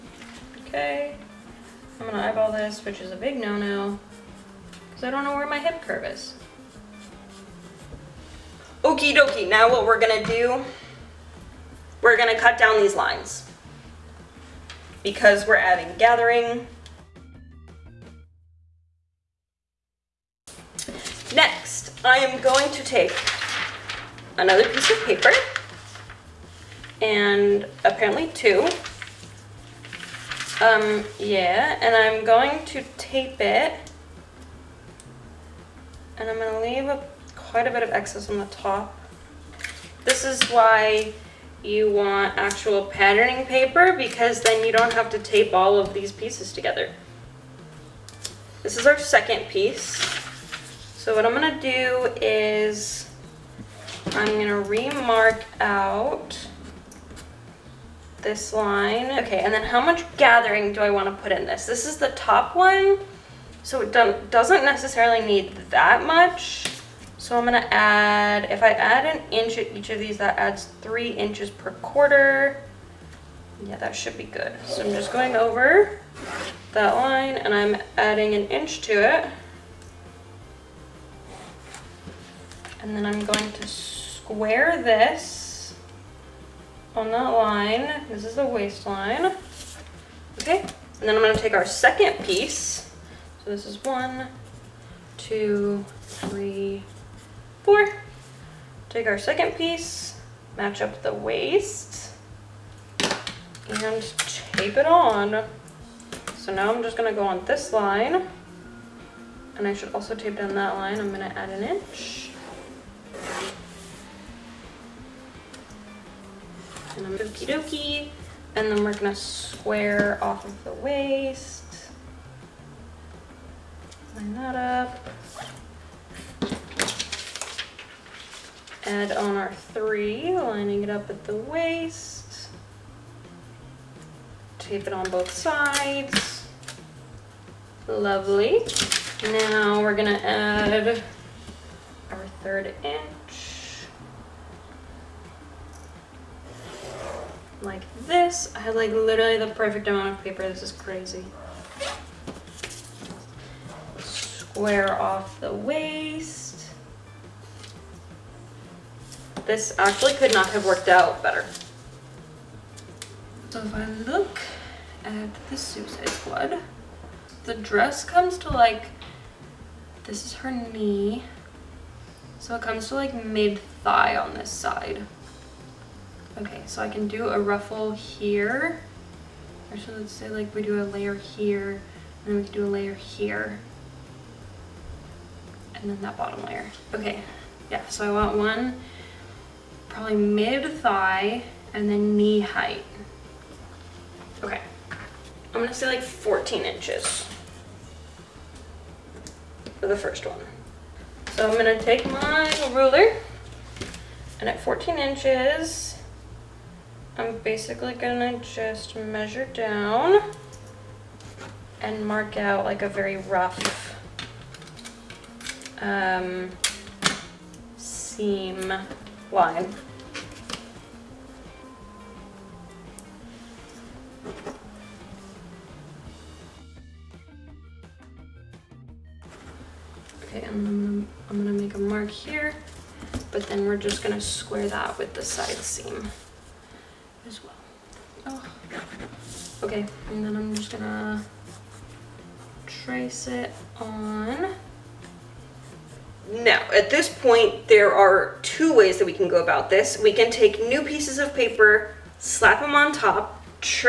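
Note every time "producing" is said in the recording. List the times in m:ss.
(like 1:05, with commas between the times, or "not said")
not said.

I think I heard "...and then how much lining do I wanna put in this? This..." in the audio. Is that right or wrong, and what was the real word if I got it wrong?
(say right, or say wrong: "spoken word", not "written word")
wrong: "gathering", not "lining".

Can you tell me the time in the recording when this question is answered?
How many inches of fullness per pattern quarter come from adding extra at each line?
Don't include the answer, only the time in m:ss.
1:10.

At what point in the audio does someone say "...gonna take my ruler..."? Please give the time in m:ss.
3:21.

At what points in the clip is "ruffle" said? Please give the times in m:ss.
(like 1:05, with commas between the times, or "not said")
2:57.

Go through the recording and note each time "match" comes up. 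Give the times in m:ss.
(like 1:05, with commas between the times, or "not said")
1:40.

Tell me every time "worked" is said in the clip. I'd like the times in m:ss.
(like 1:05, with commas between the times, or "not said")
2:40.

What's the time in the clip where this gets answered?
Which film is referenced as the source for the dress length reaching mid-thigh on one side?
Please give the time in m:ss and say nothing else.
2:45.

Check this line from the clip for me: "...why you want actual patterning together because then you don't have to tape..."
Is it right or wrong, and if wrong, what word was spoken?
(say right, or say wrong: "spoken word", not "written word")
wrong: "paper", not "together".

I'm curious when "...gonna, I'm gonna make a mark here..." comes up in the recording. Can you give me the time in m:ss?
3:50.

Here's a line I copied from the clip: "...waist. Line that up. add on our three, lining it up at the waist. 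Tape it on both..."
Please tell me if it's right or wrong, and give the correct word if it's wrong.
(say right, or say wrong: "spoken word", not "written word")
right.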